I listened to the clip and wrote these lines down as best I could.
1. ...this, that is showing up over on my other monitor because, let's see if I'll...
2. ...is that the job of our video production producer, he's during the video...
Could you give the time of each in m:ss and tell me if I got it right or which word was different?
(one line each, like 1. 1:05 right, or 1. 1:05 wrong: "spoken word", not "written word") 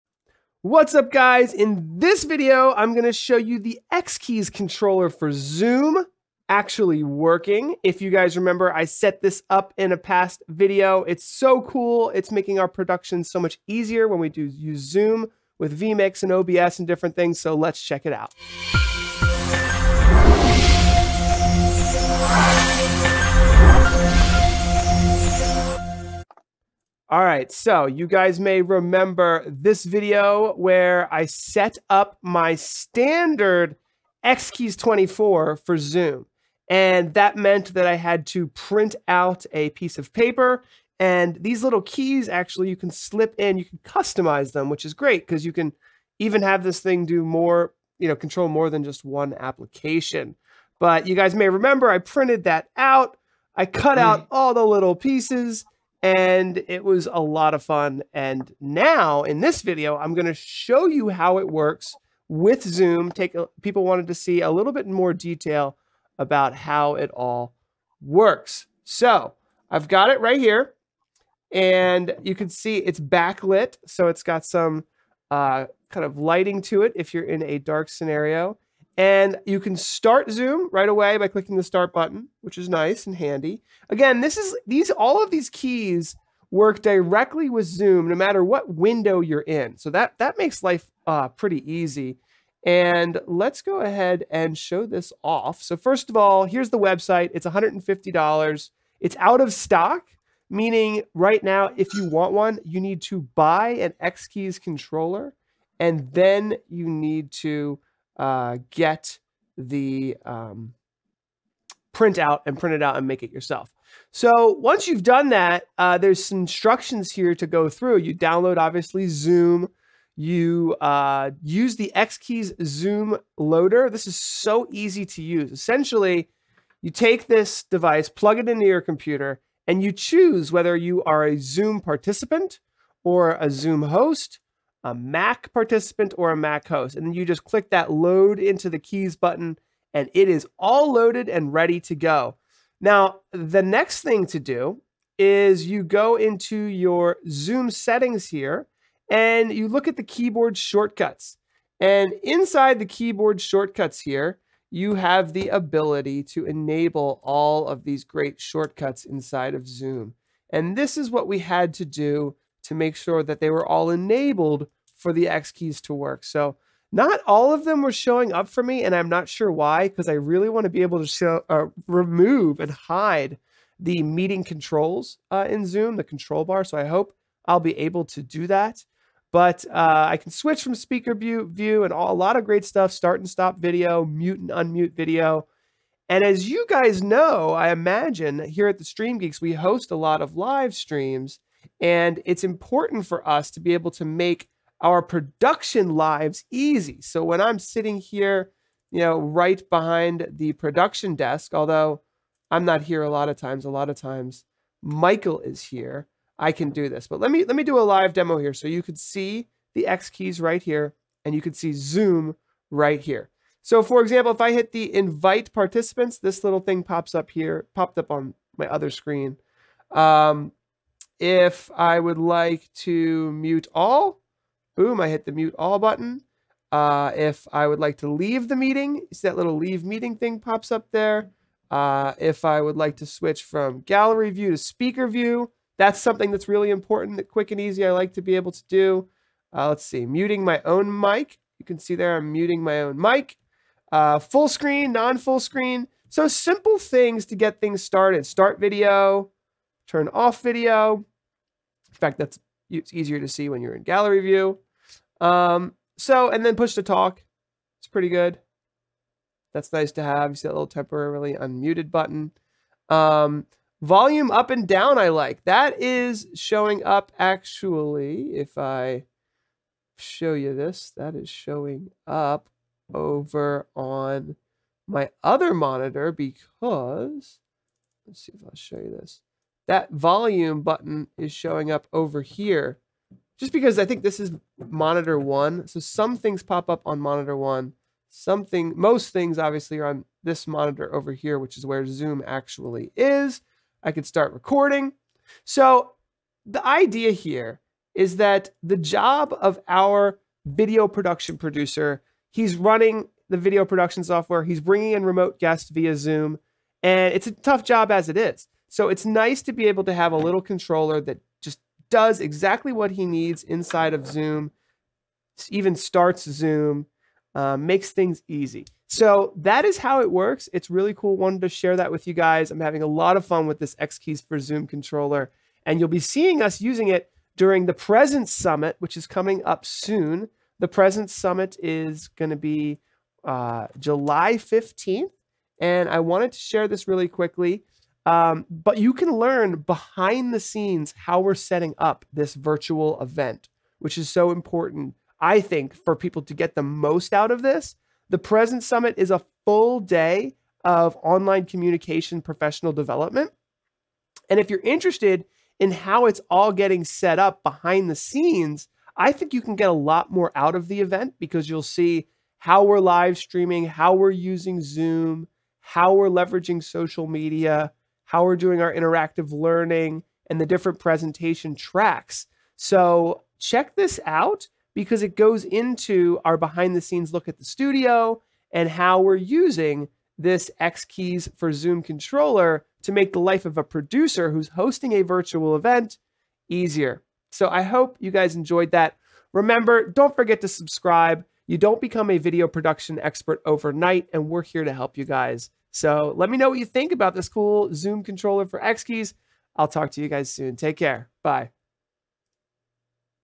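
1. 4:30 right
2. 4:57 wrong: "running", not "during".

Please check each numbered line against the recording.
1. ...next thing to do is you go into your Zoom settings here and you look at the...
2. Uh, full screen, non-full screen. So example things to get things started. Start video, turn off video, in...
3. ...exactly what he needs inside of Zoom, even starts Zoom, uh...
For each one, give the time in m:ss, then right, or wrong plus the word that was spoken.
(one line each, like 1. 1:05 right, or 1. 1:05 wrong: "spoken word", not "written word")
1. 2:23 right
2. 4:03 wrong: "simple", not "example"
3. 5:12 right.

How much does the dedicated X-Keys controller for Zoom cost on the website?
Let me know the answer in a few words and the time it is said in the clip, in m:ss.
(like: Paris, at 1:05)
$150, at 1:37.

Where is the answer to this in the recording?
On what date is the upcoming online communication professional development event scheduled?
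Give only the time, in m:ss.
5:33.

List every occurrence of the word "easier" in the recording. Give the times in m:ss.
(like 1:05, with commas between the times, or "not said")
0:13, 4:12, 6:26.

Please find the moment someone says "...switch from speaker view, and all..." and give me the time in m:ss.
3:00.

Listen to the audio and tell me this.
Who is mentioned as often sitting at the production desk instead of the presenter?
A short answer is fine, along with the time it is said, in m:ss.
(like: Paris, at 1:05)
Michael, at 3:24.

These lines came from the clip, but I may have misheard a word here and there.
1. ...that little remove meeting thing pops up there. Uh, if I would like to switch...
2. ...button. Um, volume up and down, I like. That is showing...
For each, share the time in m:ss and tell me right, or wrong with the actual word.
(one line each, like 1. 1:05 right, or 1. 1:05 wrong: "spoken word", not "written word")
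1. 3:49 wrong: "leave", not "remove"
2. 4:21 right.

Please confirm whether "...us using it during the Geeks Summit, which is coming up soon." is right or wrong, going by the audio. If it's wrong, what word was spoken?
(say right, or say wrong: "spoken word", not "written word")
wrong: "Presence", not "Geeks".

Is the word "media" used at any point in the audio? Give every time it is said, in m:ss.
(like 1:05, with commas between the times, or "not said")
6:07.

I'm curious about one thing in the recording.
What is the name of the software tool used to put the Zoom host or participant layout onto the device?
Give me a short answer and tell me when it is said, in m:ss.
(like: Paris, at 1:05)
Xkeys Zoom loader, at 2:01.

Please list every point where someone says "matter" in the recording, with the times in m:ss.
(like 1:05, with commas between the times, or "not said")
1:28.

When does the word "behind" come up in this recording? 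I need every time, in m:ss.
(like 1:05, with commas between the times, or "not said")
3:19, 5:39, 5:57, 6:16.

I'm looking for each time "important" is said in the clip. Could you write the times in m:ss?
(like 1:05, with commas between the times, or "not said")
3:12, 3:56, 5:44.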